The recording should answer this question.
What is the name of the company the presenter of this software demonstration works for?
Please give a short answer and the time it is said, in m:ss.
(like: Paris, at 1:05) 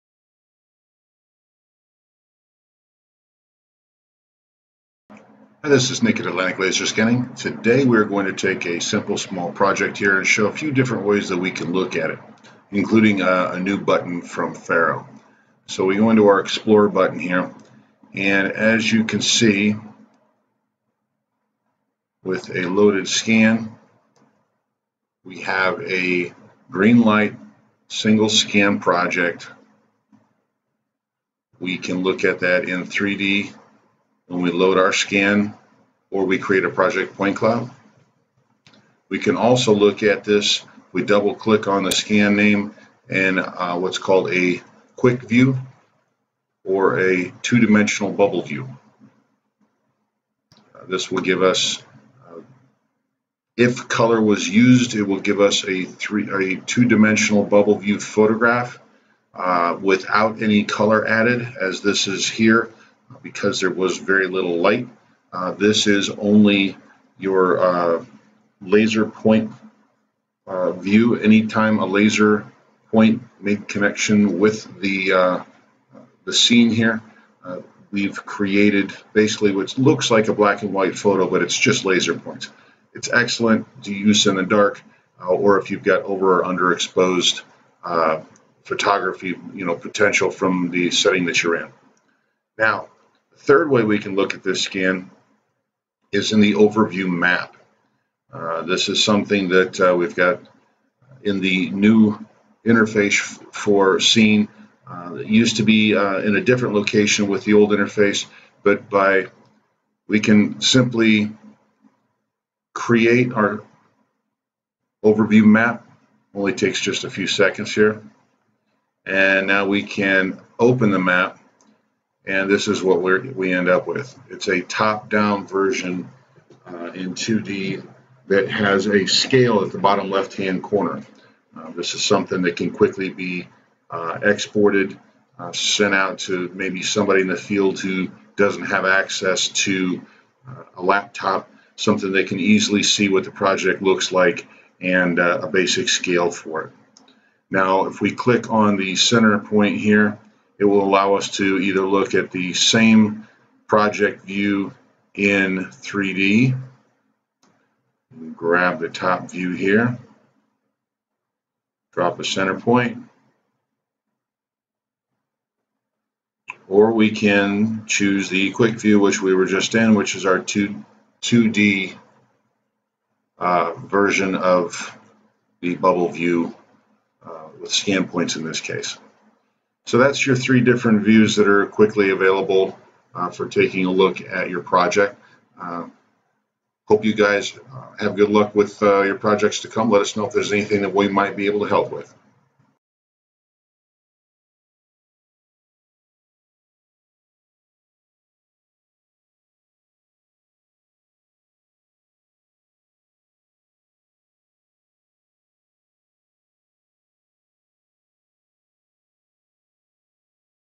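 Atlantic Laser Scanning, at 0:06.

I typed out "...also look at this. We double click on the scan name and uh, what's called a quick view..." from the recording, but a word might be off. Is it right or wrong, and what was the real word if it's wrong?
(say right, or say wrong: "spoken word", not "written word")
right.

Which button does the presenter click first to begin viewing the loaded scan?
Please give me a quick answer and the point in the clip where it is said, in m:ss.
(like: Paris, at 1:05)
Explore, at 0:16.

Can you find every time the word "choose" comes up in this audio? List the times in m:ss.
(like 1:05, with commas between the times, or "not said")
2:47.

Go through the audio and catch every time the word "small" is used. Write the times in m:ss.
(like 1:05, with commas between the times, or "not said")
0:09.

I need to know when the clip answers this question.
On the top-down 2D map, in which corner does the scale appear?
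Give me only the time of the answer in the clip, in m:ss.
2:09.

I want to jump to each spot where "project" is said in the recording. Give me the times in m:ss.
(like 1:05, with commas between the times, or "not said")
0:09, 0:28, 0:36, 2:23, 2:33, 3:04, 3:09.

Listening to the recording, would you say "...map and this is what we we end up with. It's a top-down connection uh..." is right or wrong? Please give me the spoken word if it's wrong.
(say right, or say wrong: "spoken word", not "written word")
wrong: "version", not "connection".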